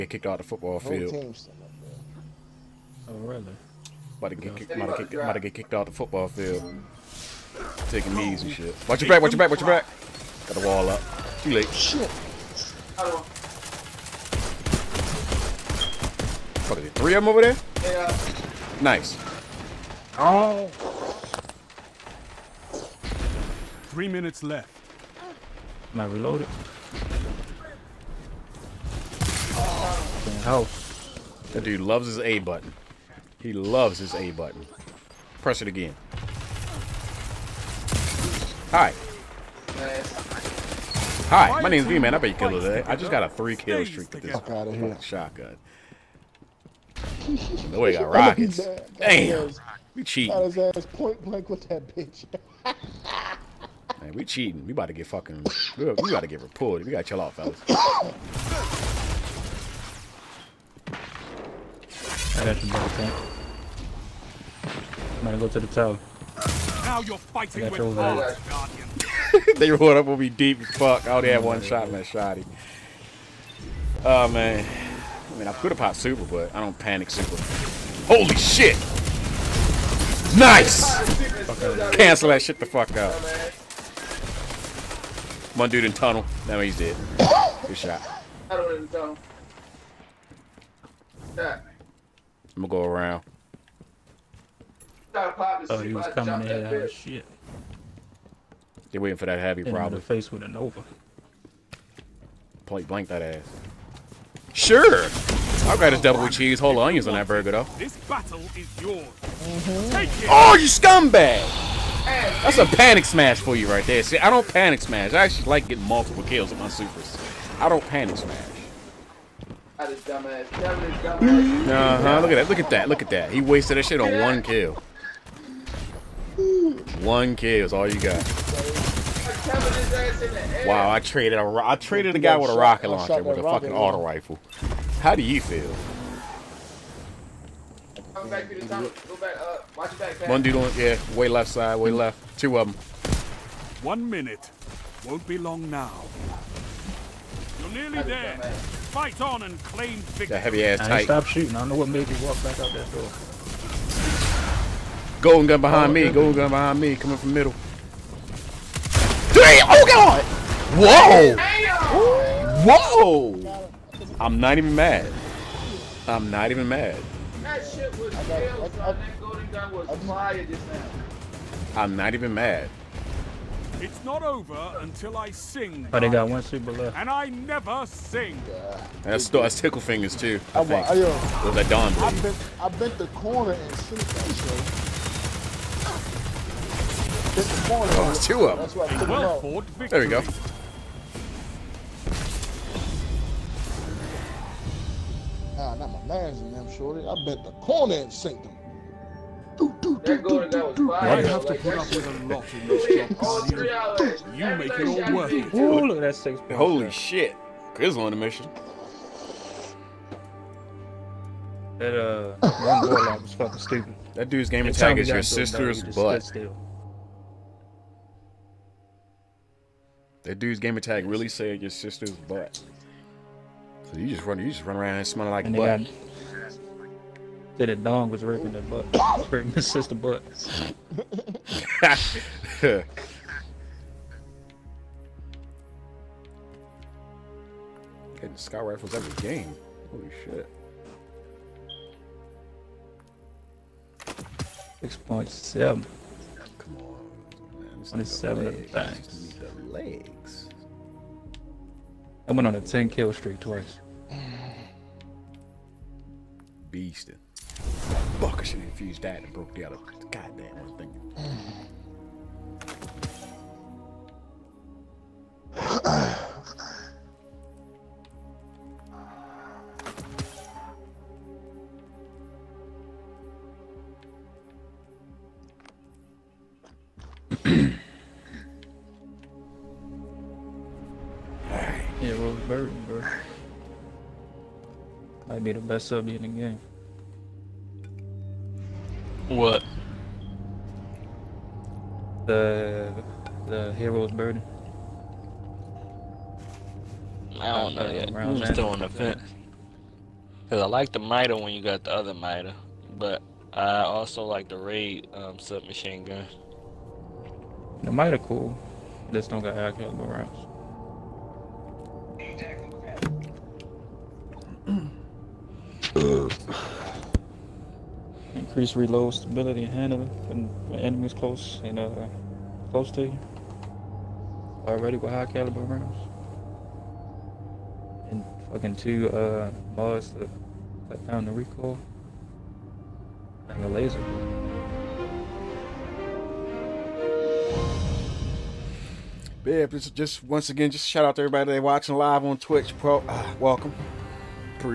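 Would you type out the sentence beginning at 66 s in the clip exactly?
Now you're fighting with odds, Guardian.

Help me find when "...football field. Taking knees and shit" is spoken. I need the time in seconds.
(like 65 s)
5 s.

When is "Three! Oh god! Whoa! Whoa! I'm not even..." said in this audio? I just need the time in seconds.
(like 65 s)
159 s.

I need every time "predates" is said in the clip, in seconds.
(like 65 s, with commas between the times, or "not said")
not said.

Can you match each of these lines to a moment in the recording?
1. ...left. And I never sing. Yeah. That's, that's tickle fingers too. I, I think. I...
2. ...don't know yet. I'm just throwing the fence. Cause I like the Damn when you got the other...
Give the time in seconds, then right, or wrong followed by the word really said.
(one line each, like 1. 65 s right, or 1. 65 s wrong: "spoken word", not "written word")
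1. 176 s right
2. 297 s wrong: "MIDA", not "Damn".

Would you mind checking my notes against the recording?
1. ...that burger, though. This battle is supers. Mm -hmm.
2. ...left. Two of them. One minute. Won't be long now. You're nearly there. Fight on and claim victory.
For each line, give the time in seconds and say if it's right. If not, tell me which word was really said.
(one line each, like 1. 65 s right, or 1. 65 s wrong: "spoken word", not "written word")
1. 107 s wrong: "yours", not "supers"
2. 141 s right.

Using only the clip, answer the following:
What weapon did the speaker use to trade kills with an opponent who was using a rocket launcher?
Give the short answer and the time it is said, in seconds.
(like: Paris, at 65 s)
auto rifle, at 133 s.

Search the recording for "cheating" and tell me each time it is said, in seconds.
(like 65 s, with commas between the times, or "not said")
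50 s, 54 s.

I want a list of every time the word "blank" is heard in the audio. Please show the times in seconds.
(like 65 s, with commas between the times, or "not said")
51 s, 102 s.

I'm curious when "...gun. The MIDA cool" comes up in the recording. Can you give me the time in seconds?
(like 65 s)
306 s.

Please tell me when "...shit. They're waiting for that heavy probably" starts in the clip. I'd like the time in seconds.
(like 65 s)
96 s.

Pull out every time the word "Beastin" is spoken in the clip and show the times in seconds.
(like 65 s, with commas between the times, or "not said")
256 s.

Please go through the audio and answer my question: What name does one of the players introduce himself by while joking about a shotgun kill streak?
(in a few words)
Veeman.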